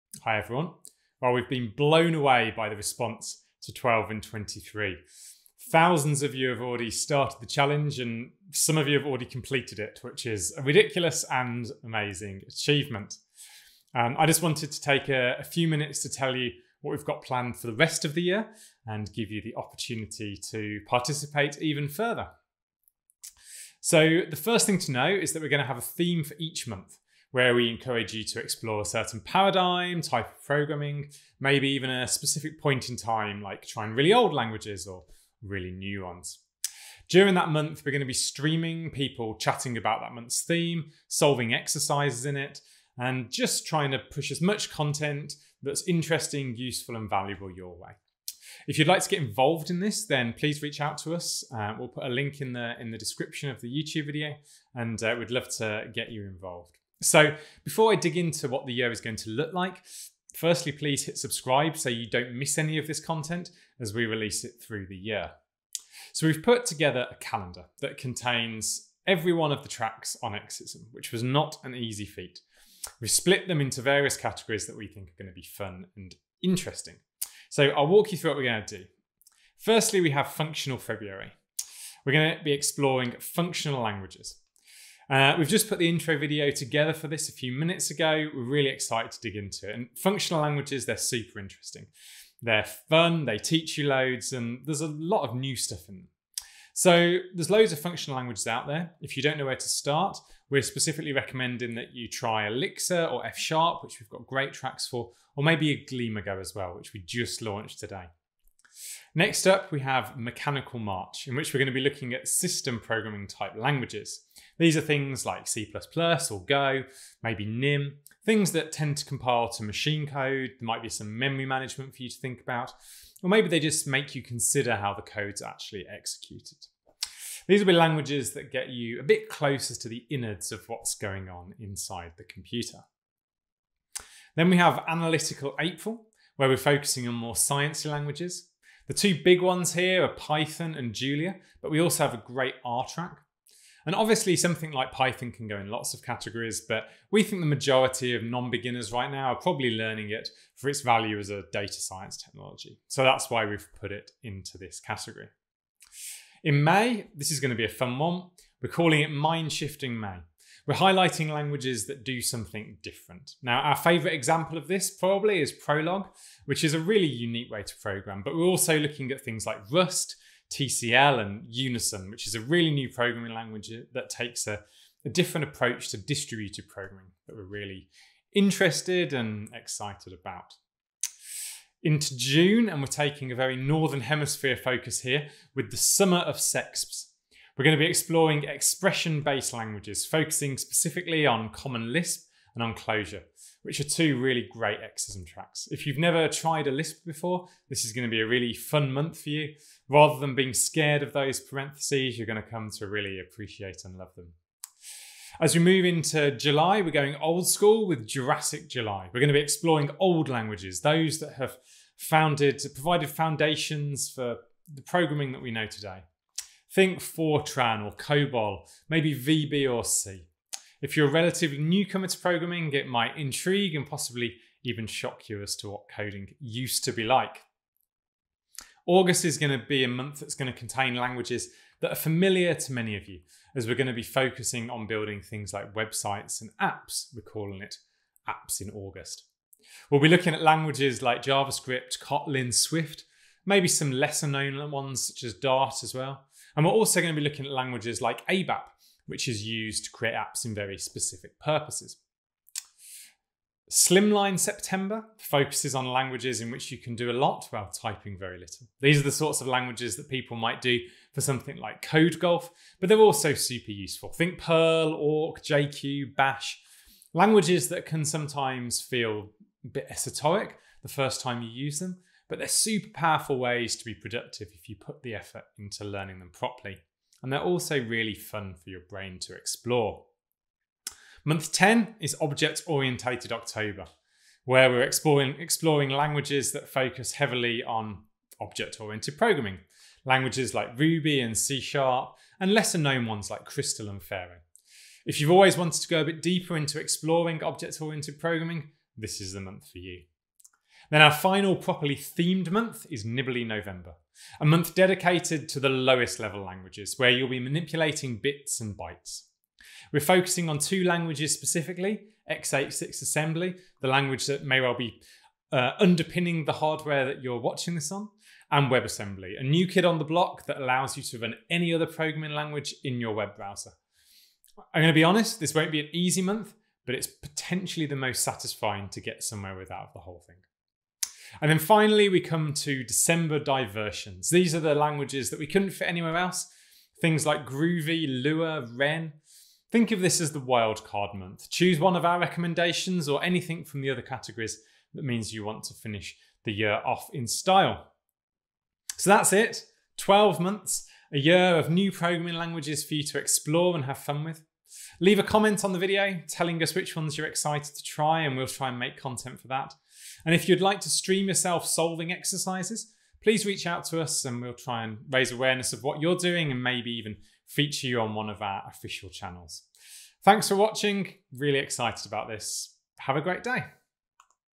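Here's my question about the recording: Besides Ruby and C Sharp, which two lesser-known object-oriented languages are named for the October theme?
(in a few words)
Crystal and Pharo.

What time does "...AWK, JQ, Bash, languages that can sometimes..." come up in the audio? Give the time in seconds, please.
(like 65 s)
264 s.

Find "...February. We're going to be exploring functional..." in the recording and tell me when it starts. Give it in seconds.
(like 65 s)
80 s.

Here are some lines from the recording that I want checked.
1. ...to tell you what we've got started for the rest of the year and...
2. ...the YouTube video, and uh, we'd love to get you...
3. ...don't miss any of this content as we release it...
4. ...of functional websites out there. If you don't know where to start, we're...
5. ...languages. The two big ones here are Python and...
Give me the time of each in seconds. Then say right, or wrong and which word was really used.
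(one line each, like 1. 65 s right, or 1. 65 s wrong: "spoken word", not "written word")
1. 16 s wrong: "planned", not "started"
2. 53 s right
3. 62 s right
4. 97 s wrong: "languages", not "websites"
5. 137 s right.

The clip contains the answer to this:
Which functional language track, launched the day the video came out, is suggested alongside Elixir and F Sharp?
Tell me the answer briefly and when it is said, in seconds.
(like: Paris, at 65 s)
Gleam, at 105 s.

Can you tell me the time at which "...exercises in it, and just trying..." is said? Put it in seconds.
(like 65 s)
41 s.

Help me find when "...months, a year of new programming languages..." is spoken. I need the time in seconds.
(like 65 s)
350 s.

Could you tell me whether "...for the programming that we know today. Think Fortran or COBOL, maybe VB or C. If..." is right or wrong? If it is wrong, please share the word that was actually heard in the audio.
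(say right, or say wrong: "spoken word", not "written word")
right.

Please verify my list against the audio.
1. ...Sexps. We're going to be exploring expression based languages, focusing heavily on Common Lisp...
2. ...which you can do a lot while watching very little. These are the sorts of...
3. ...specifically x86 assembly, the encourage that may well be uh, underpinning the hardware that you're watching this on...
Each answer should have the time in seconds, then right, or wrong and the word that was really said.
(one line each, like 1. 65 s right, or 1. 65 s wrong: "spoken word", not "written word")
1. 186 s wrong: "specifically", not "heavily"
2. 256 s wrong: "typing", not "watching"
3. 311 s wrong: "language", not "encourage".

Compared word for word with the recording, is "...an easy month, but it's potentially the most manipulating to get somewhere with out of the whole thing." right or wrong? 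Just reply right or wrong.
wrong.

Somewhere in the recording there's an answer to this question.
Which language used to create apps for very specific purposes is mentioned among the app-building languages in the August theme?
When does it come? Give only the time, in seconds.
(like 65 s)
248 s.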